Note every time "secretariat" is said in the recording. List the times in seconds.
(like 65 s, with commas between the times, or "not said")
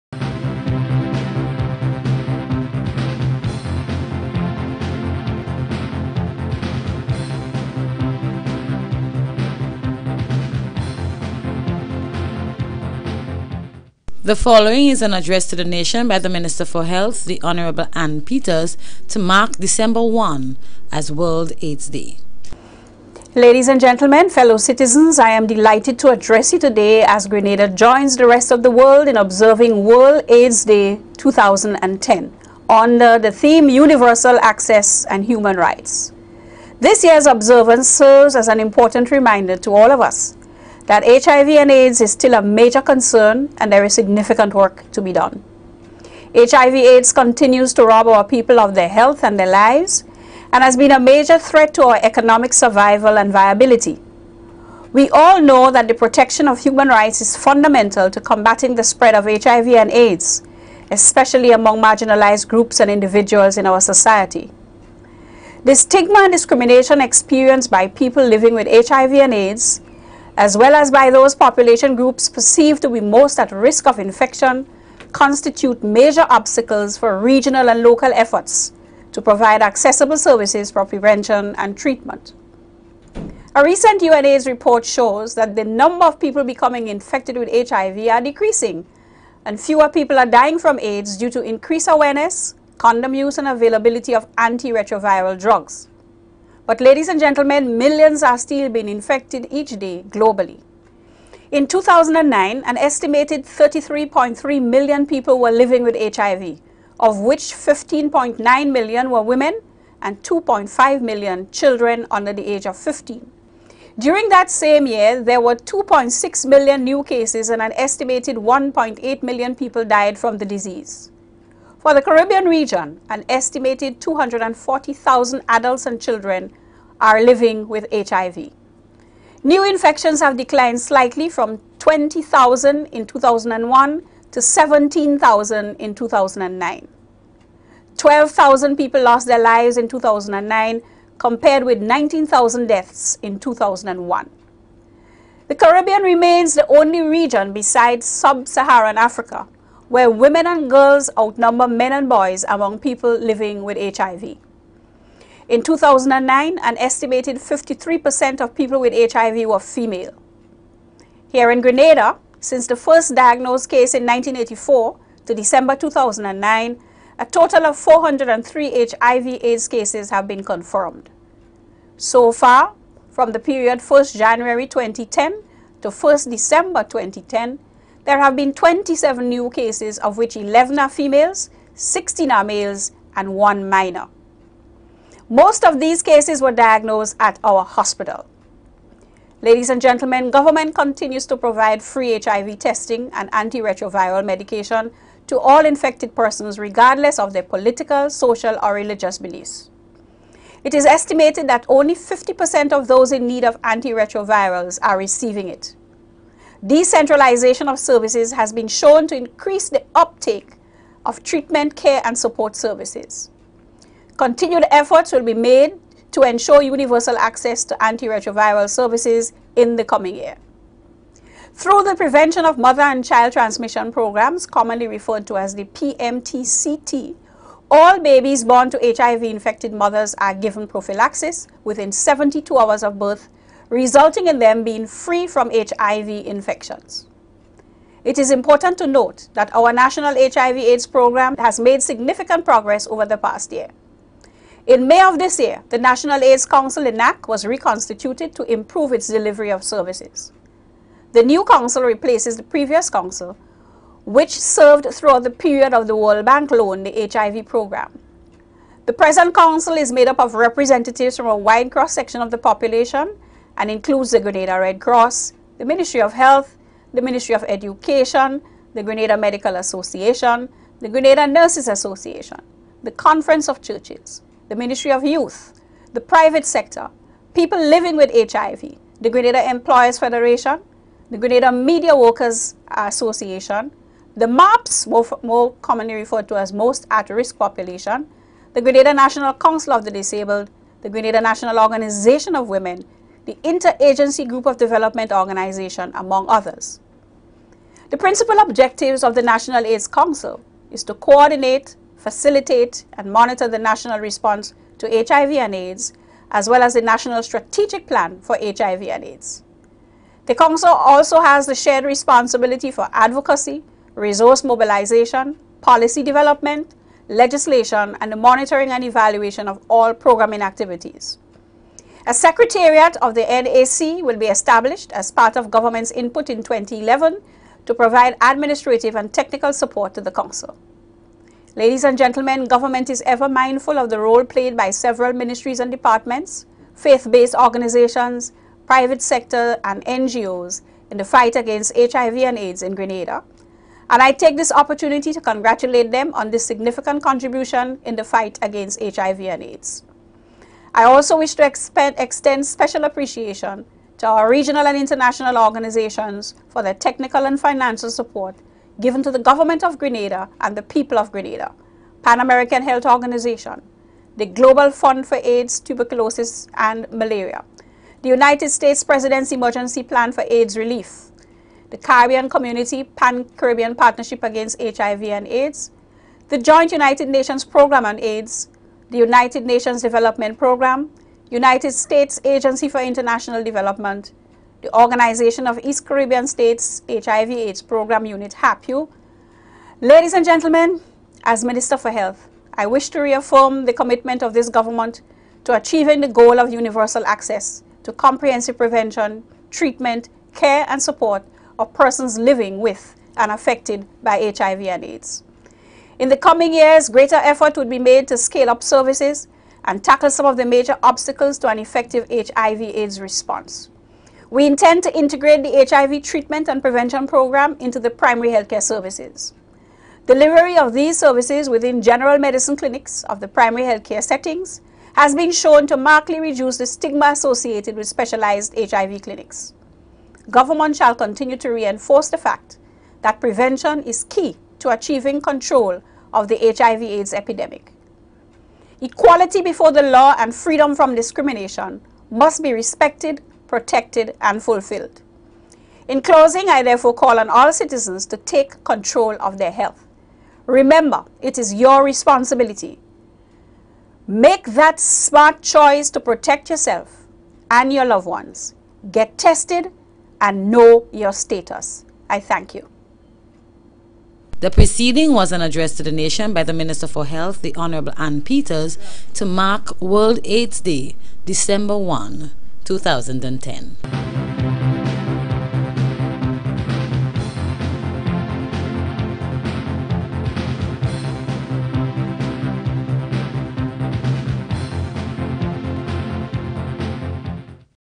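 322 s.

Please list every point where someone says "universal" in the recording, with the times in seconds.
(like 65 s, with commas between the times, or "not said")
33 s, 216 s, 396 s.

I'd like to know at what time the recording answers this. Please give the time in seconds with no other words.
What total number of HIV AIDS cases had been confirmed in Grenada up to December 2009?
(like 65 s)
167 s.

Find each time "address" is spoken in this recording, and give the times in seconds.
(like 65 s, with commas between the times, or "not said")
15 s, 26 s, 465 s.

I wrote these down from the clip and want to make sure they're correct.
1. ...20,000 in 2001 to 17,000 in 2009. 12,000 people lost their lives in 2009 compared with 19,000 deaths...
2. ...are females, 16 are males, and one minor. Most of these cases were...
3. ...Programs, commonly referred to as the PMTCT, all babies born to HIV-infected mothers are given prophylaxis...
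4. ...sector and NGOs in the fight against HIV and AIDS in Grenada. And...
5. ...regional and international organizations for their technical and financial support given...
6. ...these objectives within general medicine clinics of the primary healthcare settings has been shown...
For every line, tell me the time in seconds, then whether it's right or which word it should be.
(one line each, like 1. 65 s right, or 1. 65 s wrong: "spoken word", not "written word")
1. 131 s right
2. 180 s right
3. 223 s right
4. 339 s right
5. 354 s right
6. 420 s wrong: "services", not "objectives".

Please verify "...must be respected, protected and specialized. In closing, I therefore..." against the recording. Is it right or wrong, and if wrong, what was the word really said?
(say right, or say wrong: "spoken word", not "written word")
wrong: "fulfilled", not "specialized".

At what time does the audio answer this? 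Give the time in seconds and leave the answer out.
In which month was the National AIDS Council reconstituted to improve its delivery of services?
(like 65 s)
244 s.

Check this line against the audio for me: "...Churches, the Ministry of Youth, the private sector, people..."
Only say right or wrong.
right.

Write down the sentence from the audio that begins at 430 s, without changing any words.
Government shall continue to reinforce the fact that prevention is key to achieving control of the HIV AIDS epidemic.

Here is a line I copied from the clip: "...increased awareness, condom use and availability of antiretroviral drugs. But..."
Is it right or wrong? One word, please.
right.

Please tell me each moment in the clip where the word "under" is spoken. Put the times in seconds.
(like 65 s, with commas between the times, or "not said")
32 s, 112 s.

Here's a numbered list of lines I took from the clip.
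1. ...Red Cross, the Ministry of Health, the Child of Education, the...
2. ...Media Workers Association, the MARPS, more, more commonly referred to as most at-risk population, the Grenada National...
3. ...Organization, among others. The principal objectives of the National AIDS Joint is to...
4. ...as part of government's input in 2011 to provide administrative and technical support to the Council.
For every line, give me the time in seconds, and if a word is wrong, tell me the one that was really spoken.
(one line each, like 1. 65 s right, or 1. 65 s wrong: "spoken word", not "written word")
1. 264 s wrong: "Ministry", not "Child"
2. 281 s right
3. 295 s wrong: "Council", not "Joint"
4. 324 s right.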